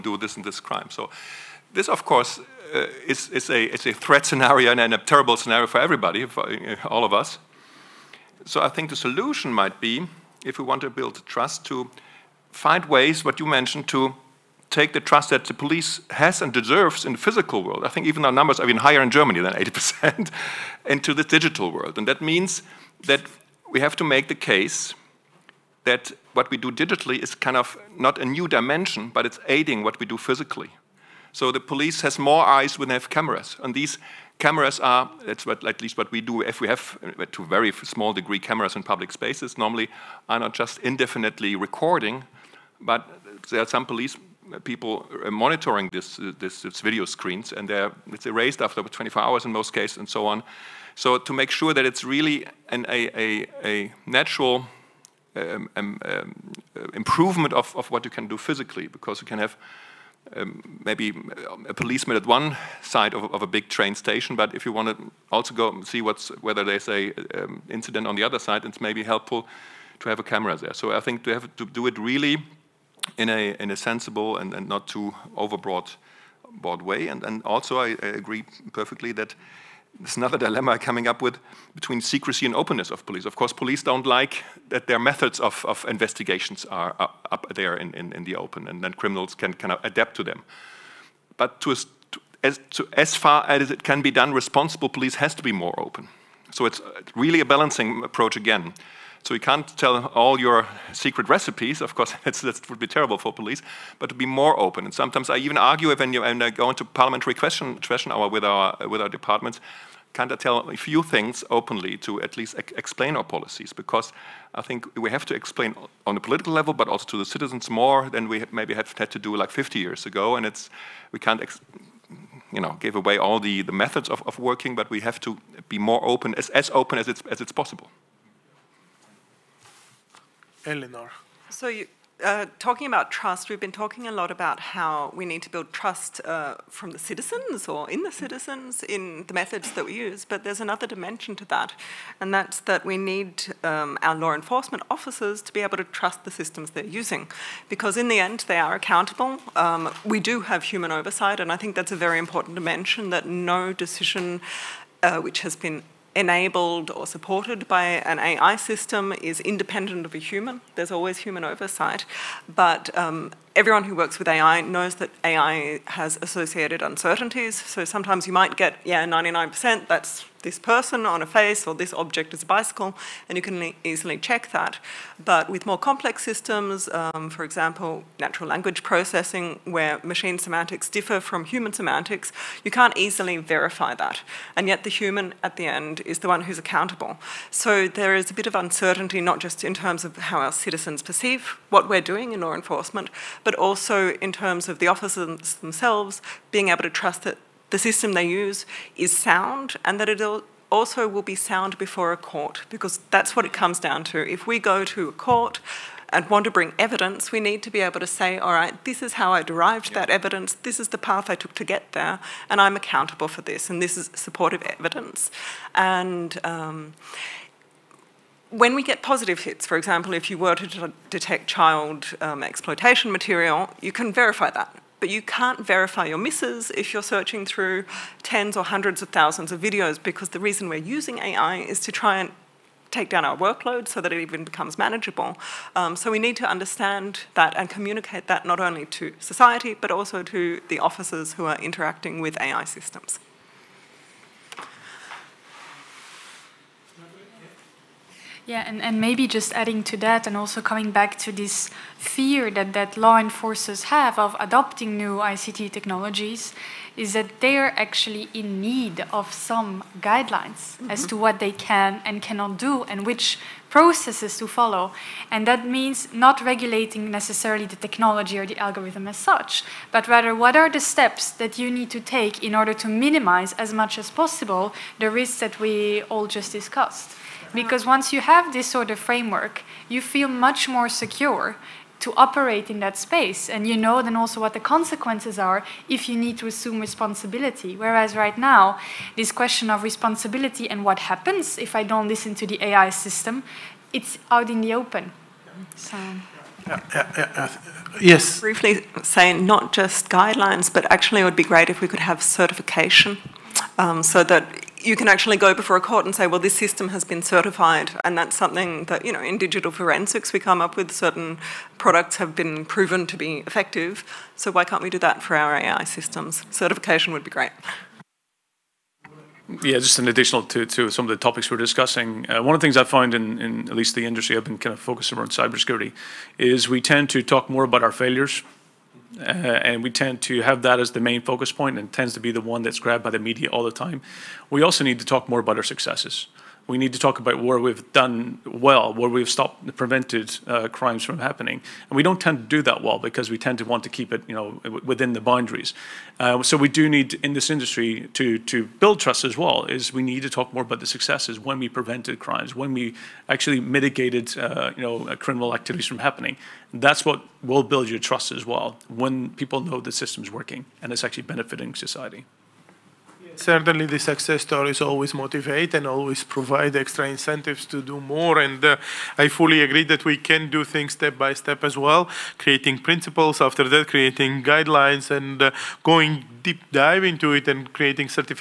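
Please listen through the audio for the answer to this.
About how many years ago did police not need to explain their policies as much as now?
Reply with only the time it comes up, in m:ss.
1:59.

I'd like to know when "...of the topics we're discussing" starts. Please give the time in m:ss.
5:21.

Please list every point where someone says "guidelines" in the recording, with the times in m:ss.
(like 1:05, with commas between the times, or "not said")
4:20, 5:00, 6:14.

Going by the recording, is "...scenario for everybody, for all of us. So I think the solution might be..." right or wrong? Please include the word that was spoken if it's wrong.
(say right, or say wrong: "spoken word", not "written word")
right.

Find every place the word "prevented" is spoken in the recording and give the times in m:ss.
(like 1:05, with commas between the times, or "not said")
5:39, 5:51.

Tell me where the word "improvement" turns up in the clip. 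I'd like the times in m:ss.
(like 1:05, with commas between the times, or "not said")
0:56.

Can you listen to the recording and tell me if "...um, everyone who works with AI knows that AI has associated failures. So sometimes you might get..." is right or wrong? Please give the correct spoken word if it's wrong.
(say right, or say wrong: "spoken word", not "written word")
wrong: "uncertainties", not "failures".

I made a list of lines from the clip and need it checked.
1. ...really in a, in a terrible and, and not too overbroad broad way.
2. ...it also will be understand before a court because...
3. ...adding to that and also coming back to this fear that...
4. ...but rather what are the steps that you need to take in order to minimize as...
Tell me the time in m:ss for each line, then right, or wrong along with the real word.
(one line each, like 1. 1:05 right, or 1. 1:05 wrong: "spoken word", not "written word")
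1. 1:11 wrong: "sensible", not "terrible"
2. 3:20 wrong: "sound", not "understand"
3. 4:09 right
4. 4:29 right.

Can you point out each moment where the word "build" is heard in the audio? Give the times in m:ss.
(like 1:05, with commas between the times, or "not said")
0:10, 2:15, 5:48, 5:57.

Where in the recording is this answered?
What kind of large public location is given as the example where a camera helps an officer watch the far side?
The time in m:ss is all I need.
1:03.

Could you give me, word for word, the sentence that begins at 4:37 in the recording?
Because once you have this sort of framework, you feel much more secure to operate in that space.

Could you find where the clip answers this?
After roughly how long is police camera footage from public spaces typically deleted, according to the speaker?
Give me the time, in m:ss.
0:48.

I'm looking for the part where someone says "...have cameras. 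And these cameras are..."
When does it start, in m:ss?
0:32.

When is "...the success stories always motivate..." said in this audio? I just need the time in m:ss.
6:03.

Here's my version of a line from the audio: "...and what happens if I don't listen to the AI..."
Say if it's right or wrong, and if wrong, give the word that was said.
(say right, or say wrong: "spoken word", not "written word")
right.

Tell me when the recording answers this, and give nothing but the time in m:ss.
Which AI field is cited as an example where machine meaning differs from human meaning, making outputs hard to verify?
2:58.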